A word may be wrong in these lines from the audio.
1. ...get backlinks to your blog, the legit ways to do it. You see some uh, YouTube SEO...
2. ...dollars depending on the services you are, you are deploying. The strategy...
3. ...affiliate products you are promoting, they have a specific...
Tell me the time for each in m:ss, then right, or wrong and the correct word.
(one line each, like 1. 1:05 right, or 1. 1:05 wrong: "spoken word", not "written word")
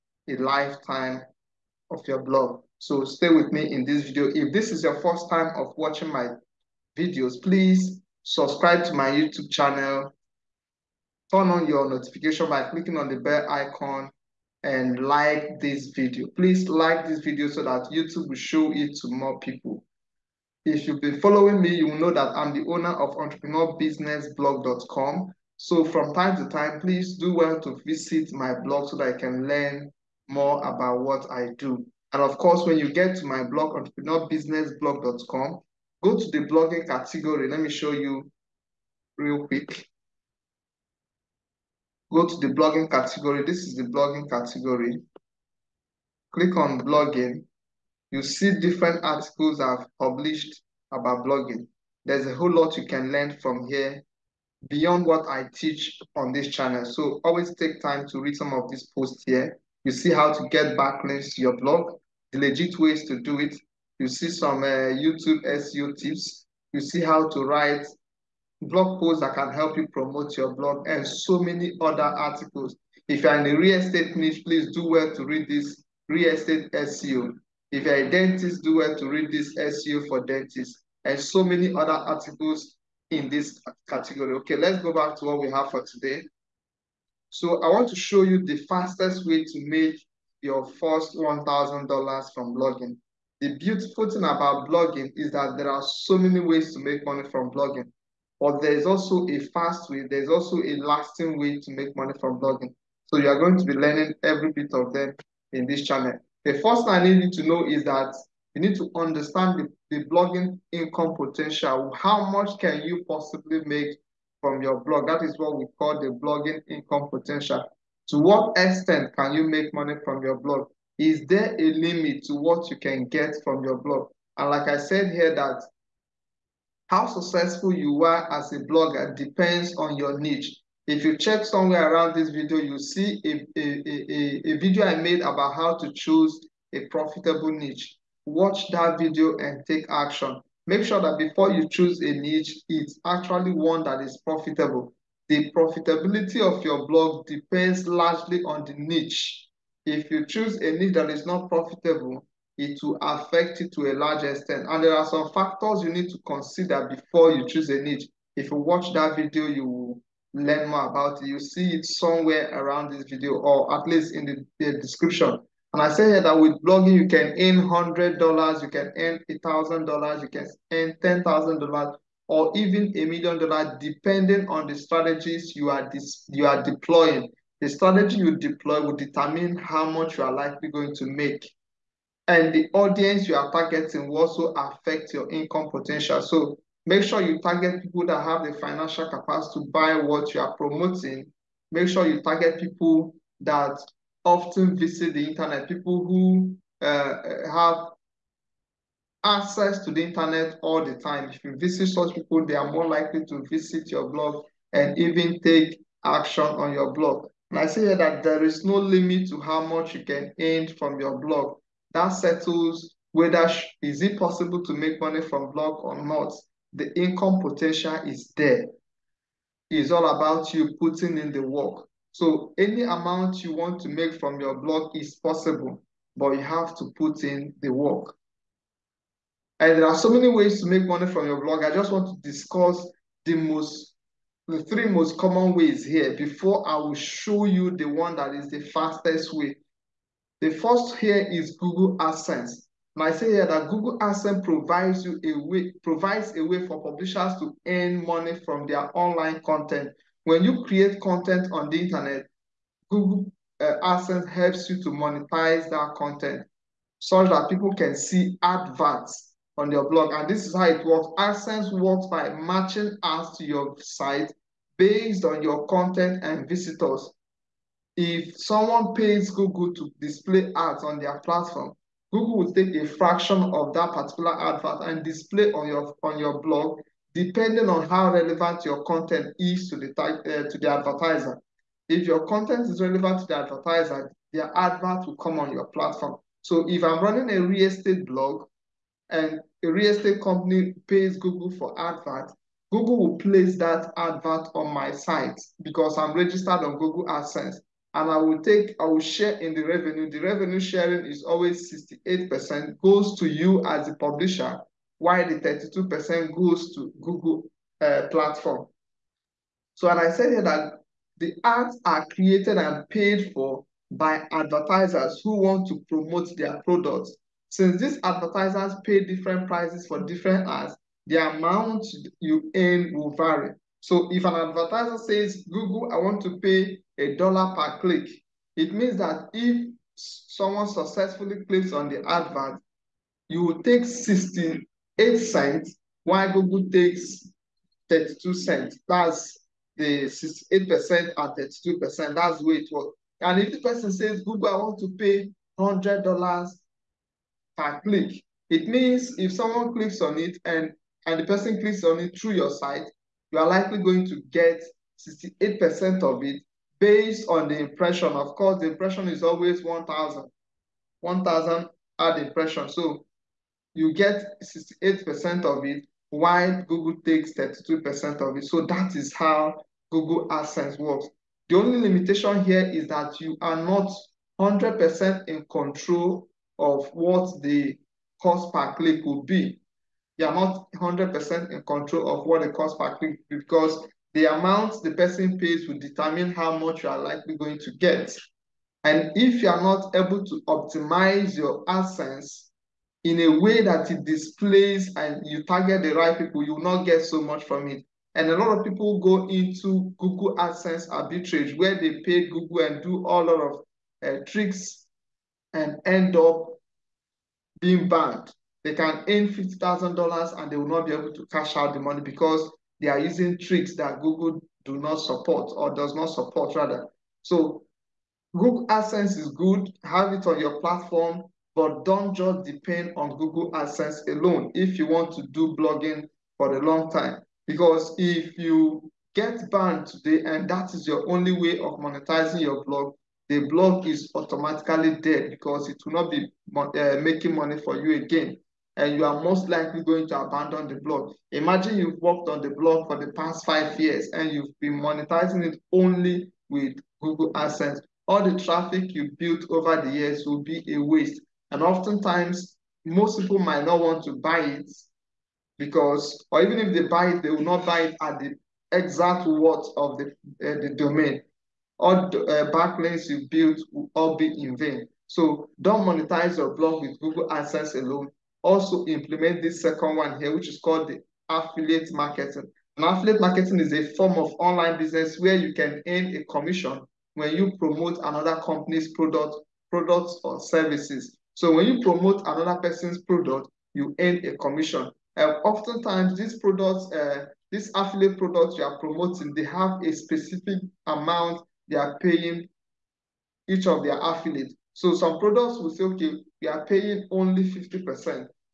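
1. 1:00 right
2. 2:53 wrong: "strategies", not "services"
3. 8:07 right.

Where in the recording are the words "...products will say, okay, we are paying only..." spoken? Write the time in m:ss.
8:15.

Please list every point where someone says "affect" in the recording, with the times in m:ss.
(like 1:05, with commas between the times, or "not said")
2:33, 3:04.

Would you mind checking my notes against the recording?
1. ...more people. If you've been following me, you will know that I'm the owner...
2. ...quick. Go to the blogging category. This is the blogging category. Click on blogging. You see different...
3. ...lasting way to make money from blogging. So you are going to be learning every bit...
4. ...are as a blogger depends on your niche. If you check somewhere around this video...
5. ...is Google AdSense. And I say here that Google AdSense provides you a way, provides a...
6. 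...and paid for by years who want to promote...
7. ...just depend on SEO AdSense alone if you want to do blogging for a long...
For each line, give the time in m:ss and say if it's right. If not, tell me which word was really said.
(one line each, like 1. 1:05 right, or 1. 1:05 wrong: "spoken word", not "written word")
1. 0:19 right
2. 0:39 right
3. 1:40 right
4. 2:08 right
5. 4:01 right
6. 5:12 wrong: "advertisers", not "years"
7. 7:02 wrong: "Google", not "SEO".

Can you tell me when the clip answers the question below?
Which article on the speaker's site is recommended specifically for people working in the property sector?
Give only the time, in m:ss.
1:16.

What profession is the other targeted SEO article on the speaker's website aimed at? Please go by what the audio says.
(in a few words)
Dentists.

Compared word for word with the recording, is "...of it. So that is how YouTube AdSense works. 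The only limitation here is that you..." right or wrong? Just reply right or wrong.
wrong.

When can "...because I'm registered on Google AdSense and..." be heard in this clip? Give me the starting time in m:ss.
4:55.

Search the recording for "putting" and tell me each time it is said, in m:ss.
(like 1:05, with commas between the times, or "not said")
3:40.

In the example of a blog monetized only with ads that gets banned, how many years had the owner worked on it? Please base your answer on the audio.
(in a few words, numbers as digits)
5 years.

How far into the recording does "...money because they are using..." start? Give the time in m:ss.
6:51.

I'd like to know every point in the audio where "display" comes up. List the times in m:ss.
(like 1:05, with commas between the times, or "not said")
4:30, 4:35, 6:34.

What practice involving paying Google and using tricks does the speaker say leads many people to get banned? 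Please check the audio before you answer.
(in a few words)
Google AdSense arbitrage.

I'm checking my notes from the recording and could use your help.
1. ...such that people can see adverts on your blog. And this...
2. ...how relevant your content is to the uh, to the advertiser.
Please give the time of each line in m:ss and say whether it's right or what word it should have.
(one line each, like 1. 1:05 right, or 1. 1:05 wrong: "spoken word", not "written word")
1. 4:16 right
2. 4:37 right.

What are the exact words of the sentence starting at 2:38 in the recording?
If you watch that video, you will learn more about it.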